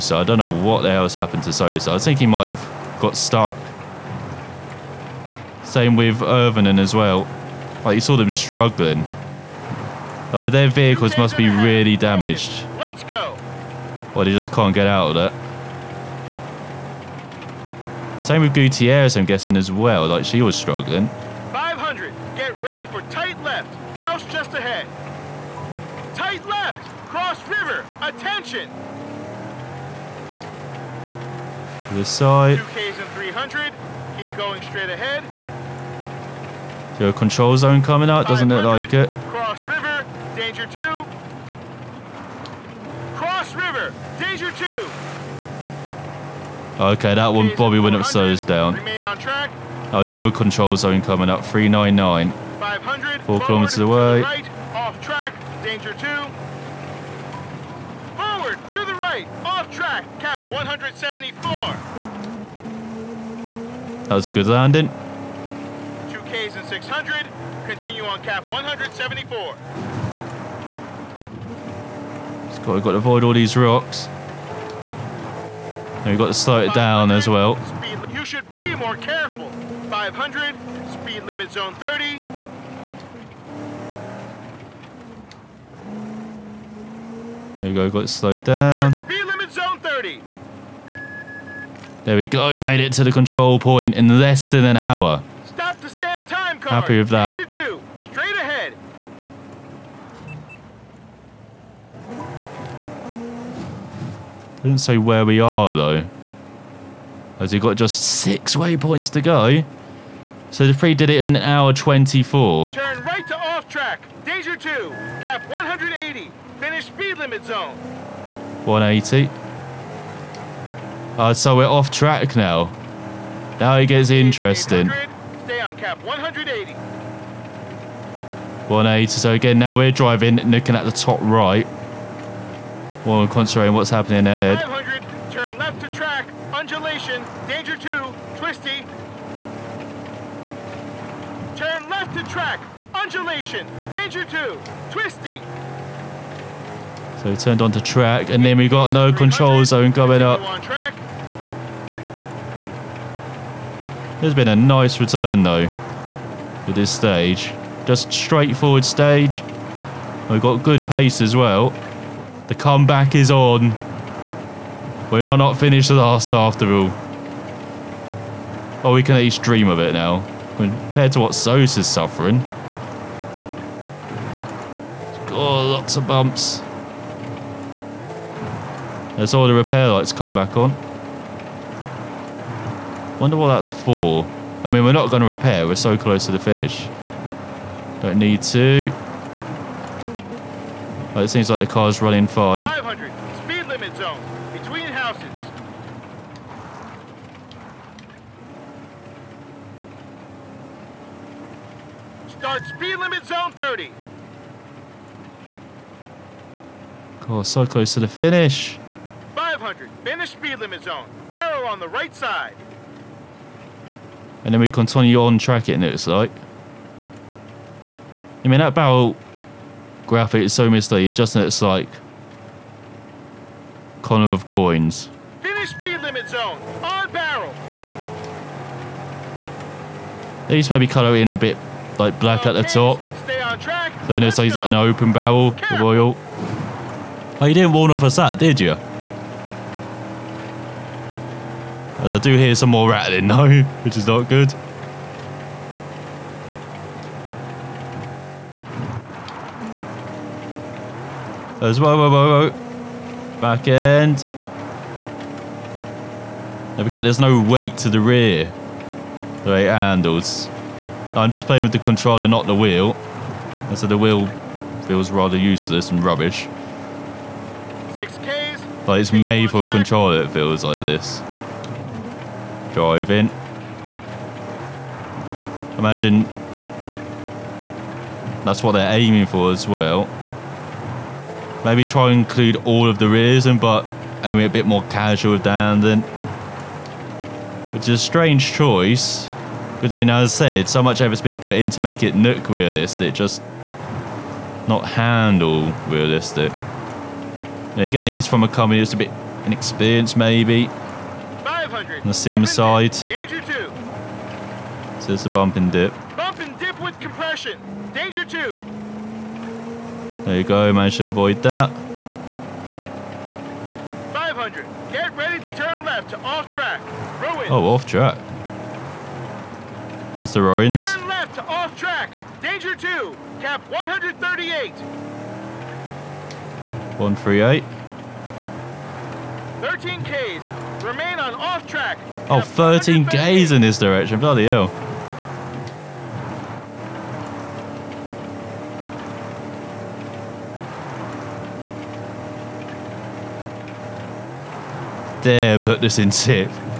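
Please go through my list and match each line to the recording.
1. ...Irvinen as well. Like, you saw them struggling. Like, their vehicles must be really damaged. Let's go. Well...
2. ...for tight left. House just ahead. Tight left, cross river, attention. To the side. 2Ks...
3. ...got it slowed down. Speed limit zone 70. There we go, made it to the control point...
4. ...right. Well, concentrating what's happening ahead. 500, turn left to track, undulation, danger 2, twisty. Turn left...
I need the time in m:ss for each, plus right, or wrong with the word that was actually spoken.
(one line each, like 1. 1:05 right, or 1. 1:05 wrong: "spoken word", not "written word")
1. 0:06 right
2. 0:22 right
3. 1:27 wrong: "30", not "70"
4. 2:11 right.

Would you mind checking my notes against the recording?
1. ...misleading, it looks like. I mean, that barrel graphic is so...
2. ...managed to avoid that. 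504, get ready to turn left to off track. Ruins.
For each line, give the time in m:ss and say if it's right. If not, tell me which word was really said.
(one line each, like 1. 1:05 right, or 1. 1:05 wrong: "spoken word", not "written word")
1. 3:35 wrong: "tracking", not "misleading"
2. 5:10 wrong: "500", not "504".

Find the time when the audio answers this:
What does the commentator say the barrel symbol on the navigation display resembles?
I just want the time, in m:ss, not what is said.
3:44.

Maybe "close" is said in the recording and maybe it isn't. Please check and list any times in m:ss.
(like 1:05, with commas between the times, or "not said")
3:05, 3:27.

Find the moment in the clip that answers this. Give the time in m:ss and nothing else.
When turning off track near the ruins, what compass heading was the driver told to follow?
5:23.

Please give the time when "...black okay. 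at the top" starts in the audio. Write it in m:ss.
3:52.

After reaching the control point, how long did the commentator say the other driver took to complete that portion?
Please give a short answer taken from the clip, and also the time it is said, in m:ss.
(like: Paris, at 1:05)
an hour 24, at 1:51.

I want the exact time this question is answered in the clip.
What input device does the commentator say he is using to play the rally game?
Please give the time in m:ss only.
4:21.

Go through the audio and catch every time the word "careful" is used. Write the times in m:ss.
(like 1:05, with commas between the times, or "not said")
1:18.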